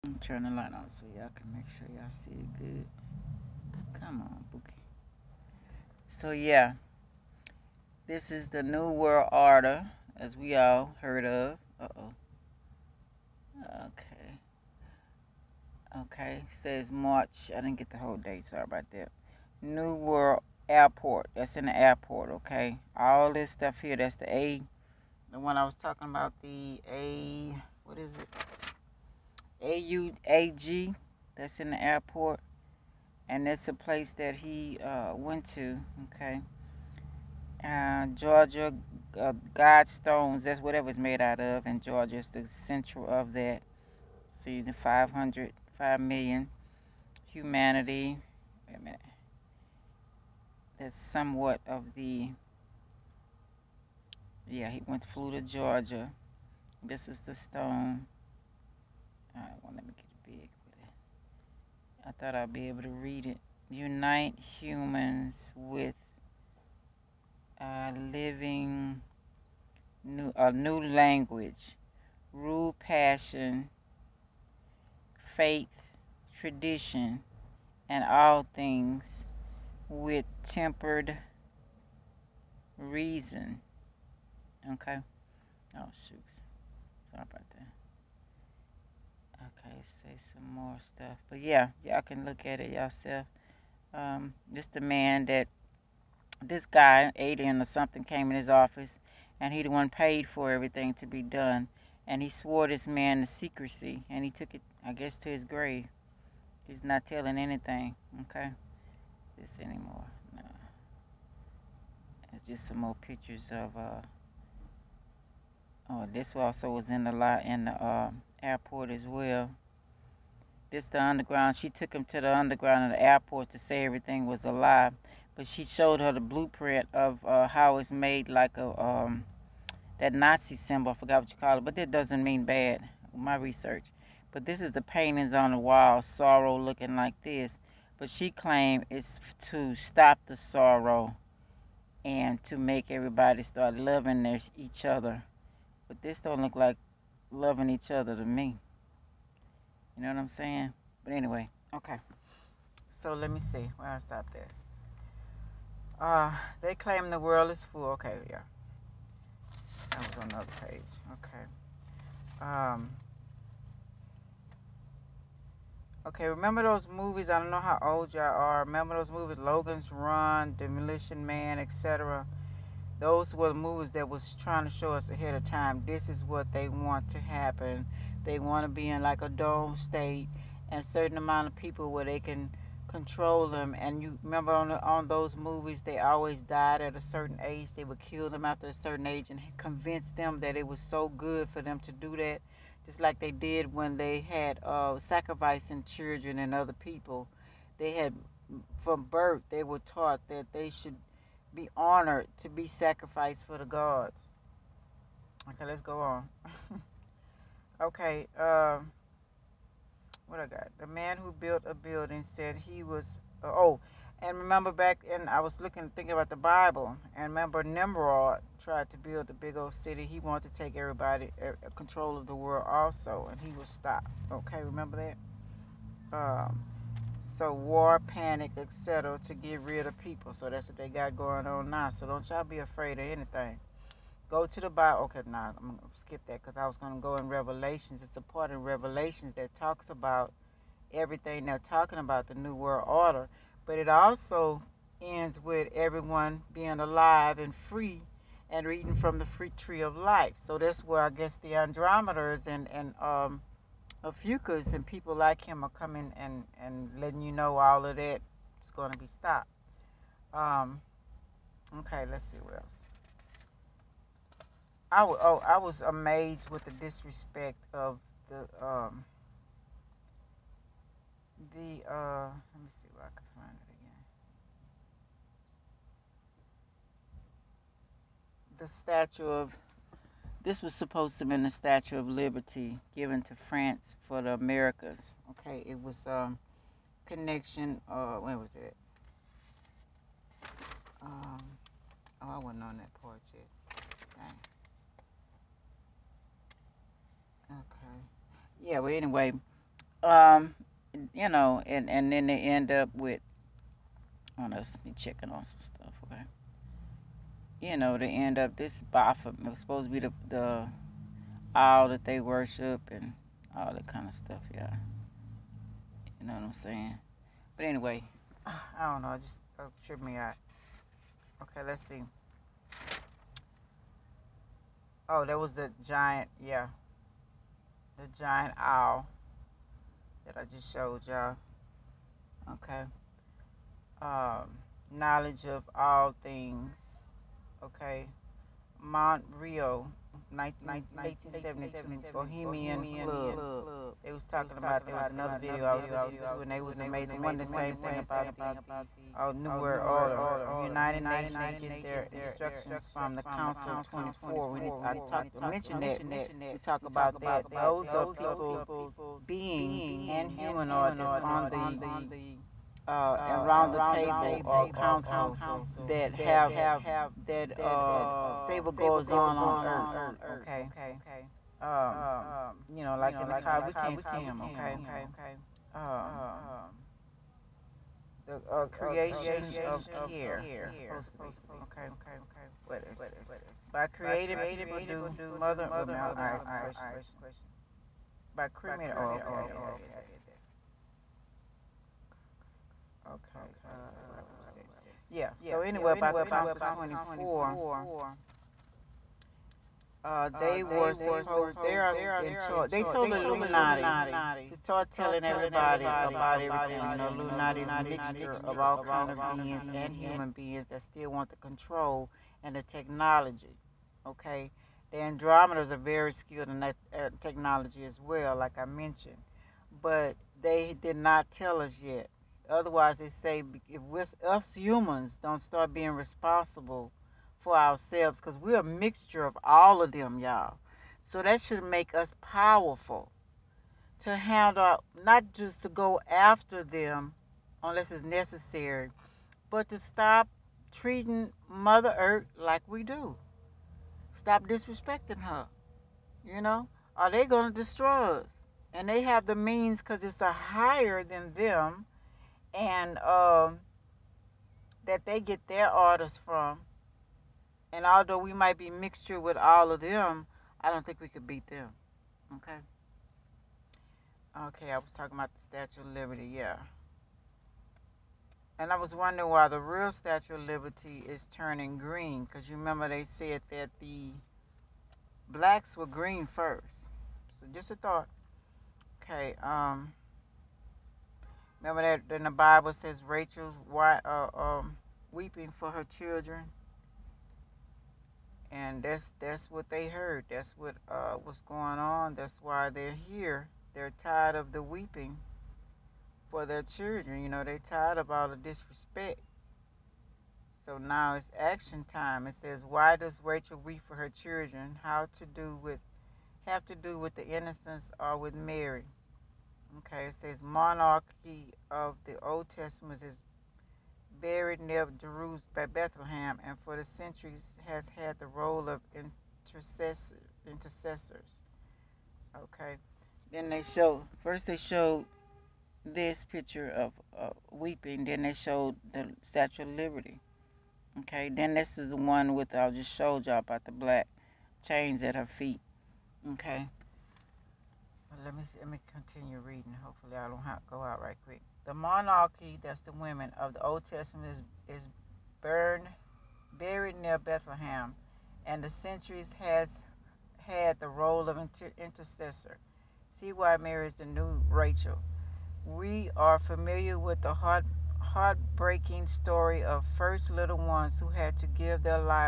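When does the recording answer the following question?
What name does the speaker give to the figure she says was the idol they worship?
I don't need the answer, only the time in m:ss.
5:08.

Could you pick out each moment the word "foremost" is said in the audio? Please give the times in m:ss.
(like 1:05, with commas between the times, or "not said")
not said.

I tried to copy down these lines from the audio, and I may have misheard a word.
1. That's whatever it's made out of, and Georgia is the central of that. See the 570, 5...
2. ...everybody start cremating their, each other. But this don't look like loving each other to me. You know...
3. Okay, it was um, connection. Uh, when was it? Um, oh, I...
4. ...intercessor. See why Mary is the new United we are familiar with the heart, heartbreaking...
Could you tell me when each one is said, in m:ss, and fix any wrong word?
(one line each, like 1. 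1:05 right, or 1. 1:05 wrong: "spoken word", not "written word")
1. 0:40 wrong: "500", not "570"
2. 2:22 wrong: "loving", not "cremating"
3. 4:45 right
4. 9:11 wrong: "Rachel", not "United".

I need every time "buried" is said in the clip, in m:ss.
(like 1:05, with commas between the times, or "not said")
8:34, 9:06.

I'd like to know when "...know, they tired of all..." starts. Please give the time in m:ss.
8:17.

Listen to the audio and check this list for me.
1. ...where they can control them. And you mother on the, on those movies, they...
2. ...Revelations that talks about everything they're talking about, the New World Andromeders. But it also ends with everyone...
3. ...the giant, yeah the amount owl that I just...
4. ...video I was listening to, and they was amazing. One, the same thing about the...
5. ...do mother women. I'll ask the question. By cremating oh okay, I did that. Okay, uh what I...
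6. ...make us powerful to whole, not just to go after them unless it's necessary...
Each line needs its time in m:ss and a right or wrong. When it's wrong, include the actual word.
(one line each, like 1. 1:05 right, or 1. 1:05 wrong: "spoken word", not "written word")
1. 3:01 wrong: "remember", not "mother"
2. 3:58 wrong: "Order", not "Andromeders"
3. 5:25 wrong: "giant", not "amount"
4. 5:45 right
5. 6:24 right
6. 7:11 wrong: "handle", not "whole".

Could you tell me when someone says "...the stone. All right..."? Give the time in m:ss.
0:57.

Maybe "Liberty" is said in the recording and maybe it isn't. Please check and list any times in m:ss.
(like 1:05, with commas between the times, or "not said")
4:42, 7:45, 7:50, 8:49.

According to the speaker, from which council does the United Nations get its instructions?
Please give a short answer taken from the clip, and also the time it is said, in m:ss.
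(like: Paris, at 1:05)
Council of 24, at 5:53.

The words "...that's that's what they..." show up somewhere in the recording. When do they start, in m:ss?
8:08.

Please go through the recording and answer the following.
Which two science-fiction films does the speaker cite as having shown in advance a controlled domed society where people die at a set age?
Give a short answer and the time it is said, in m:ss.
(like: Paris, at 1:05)
Logan's Run, Demolition Man, at 2:49.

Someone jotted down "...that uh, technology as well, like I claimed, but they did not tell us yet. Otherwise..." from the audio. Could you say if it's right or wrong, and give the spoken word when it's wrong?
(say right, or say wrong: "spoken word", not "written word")
wrong: "mentioned", not "claimed".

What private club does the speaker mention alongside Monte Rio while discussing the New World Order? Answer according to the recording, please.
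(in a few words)
Bohemian Club.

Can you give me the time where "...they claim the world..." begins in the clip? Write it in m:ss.
2:36.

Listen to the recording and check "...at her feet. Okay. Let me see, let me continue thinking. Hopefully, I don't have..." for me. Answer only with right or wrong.
wrong.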